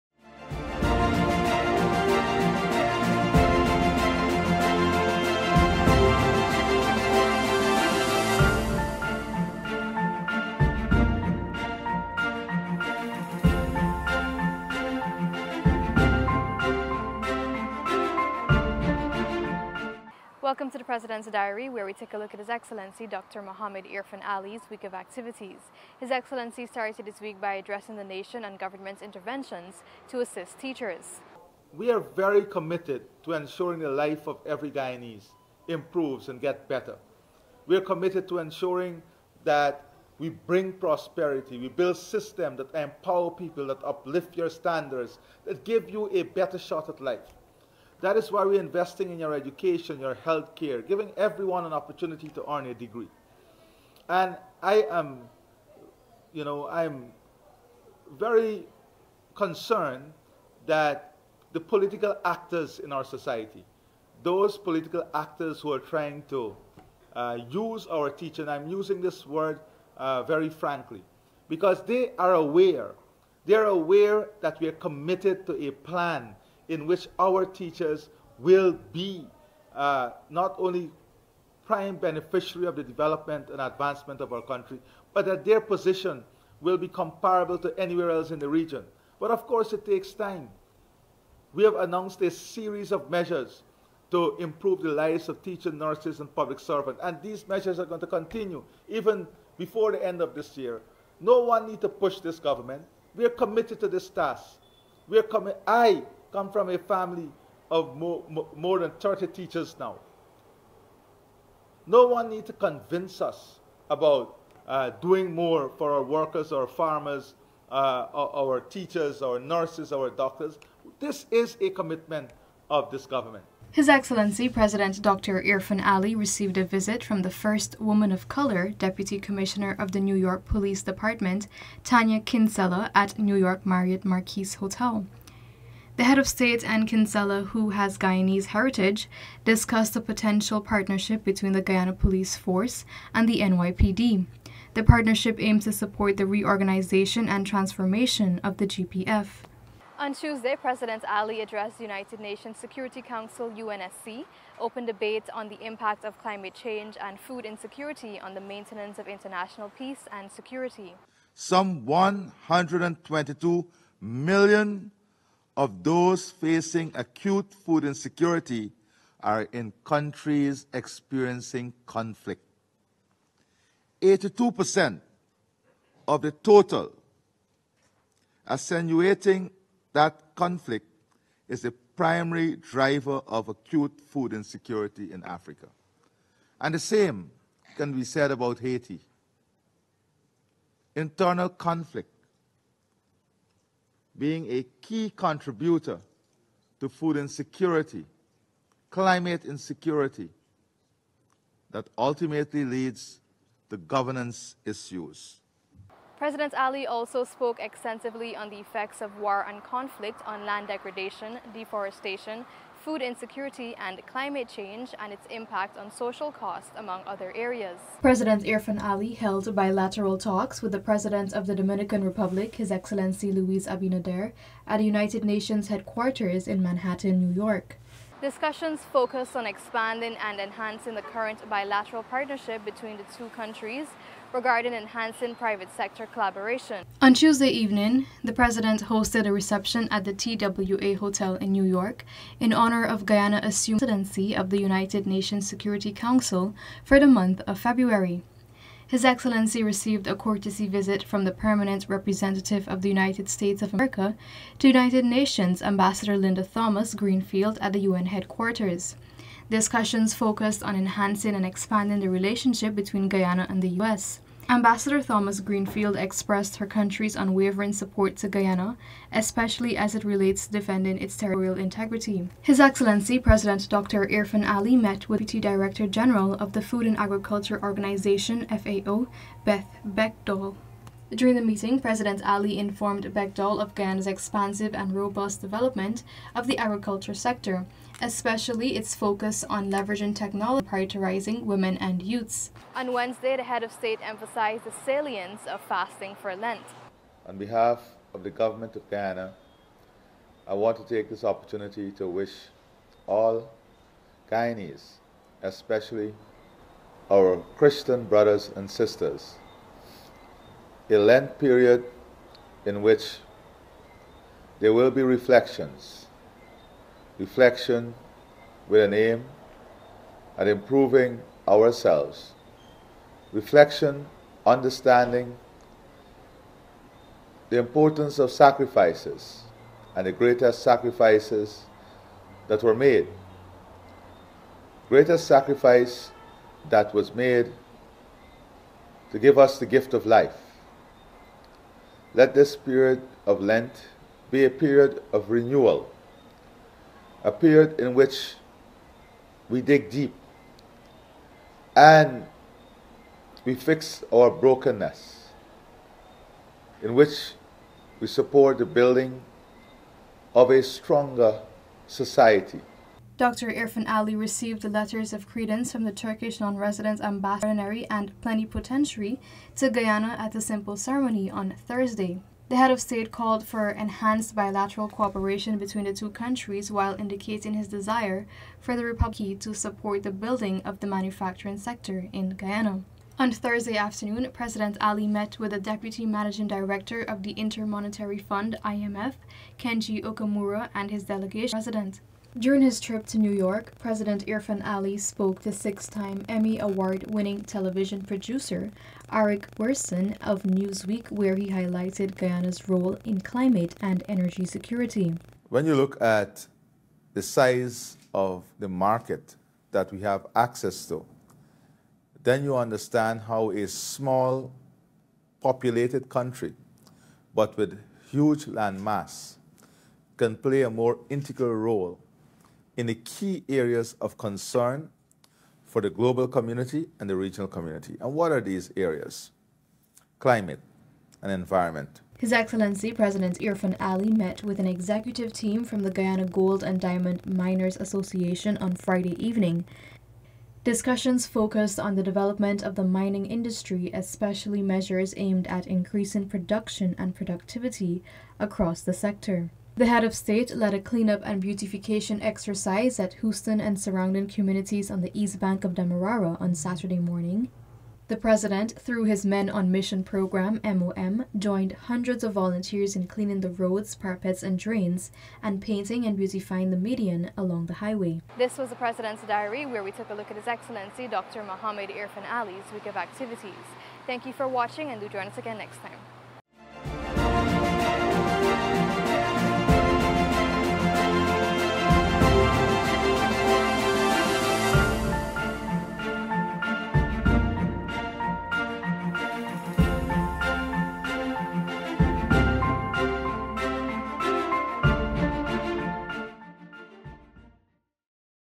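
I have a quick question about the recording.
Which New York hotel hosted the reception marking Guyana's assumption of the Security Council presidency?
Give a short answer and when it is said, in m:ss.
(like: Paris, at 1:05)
TWA Hotel, at 4:00.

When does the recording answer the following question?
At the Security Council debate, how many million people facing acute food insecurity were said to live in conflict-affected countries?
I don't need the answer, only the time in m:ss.
2:41.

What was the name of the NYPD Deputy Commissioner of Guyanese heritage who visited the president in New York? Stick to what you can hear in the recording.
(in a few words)
Tania Kinsella.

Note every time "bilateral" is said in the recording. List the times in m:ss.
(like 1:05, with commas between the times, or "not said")
3:39, 3:51, 6:14.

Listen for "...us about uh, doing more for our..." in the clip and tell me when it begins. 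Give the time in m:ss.
1:53.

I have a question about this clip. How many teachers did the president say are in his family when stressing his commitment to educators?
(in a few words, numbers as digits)
more than 30.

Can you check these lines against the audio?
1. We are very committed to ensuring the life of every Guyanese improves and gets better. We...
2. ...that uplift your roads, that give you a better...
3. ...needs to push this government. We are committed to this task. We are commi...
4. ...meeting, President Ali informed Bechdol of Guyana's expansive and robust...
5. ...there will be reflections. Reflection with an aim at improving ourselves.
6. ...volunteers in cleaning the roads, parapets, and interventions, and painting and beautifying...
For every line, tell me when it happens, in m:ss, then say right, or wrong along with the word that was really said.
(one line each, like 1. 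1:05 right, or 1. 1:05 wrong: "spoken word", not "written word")
1. 0:31 right
2. 0:43 wrong: "standards", not "roads"
3. 1:41 right
4. 4:41 right
5. 5:14 right
6. 7:42 wrong: "drains", not "interventions".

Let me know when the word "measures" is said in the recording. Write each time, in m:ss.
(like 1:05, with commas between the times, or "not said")
1:33, 1:37, 7:24.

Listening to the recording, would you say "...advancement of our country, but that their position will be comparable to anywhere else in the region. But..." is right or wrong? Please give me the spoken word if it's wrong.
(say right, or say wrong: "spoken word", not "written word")
right.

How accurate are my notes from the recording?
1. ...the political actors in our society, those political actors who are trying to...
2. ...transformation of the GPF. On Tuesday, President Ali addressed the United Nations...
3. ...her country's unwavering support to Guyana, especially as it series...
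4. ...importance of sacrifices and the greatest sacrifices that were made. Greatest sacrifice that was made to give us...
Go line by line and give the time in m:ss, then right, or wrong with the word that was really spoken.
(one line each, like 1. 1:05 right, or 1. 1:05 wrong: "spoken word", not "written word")
1. 1:01 right
2. 2:27 right
3. 4:26 wrong: "relates", not "series"
4. 5:27 right.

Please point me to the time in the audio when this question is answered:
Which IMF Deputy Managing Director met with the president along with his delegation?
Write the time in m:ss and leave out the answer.
6:29.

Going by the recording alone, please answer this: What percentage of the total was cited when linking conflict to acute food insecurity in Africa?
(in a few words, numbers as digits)
82%.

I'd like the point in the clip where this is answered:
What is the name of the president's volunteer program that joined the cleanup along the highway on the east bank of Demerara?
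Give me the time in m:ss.
7:39.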